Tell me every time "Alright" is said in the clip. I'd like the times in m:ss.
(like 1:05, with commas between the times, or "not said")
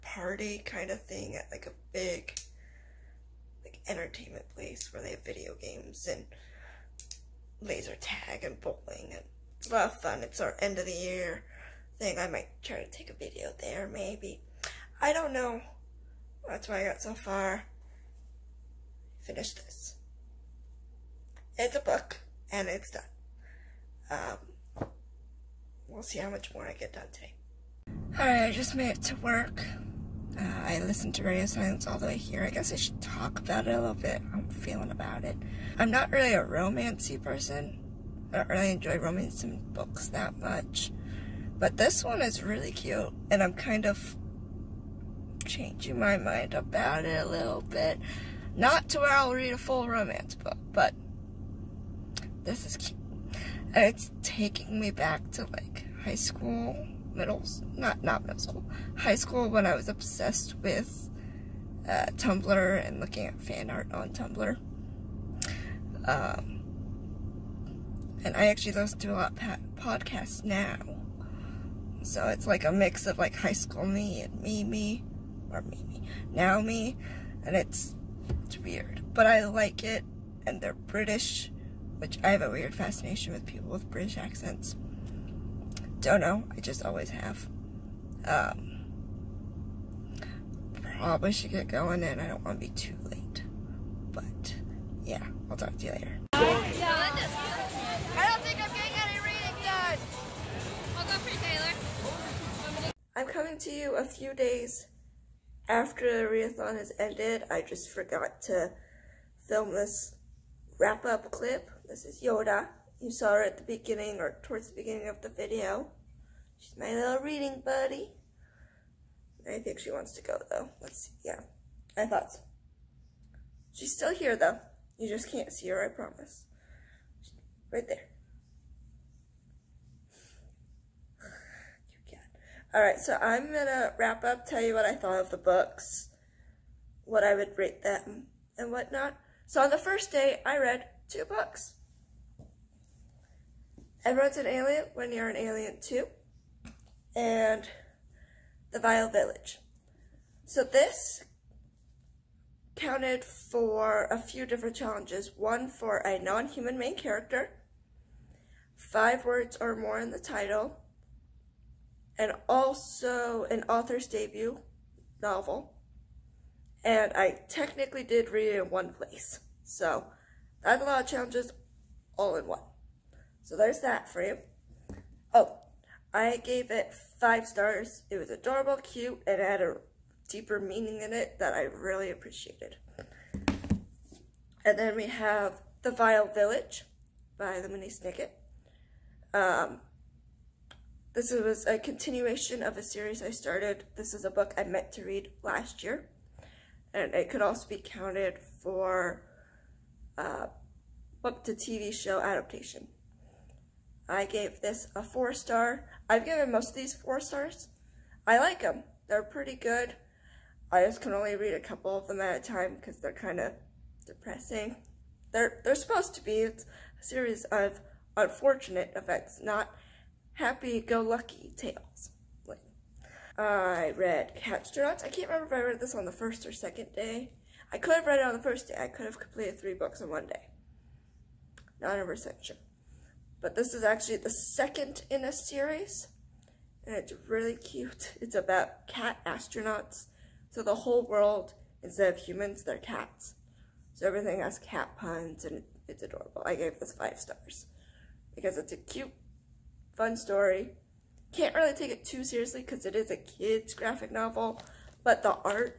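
0:28, 2:12.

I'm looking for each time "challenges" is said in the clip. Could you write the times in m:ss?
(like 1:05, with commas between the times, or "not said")
2:34, 2:51.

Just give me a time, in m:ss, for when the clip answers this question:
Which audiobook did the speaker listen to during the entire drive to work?
0:31.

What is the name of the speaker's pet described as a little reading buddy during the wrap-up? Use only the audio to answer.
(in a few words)
Yoda.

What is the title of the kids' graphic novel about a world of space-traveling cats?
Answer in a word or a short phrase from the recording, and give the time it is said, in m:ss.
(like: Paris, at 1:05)
Catstronauts, at 3:44.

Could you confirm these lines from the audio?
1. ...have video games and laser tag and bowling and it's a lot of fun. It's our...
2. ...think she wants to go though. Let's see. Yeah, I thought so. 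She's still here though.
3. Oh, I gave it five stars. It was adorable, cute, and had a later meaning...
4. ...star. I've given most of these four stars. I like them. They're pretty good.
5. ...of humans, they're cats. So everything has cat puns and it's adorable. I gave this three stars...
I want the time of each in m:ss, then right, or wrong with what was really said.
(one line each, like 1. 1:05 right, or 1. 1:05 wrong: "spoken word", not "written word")
1. 0:05 right
2. 1:59 right
3. 2:55 wrong: "deeper", not "later"
4. 3:25 right
5. 4:02 wrong: "five", not "three".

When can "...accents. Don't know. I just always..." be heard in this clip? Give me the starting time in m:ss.
1:24.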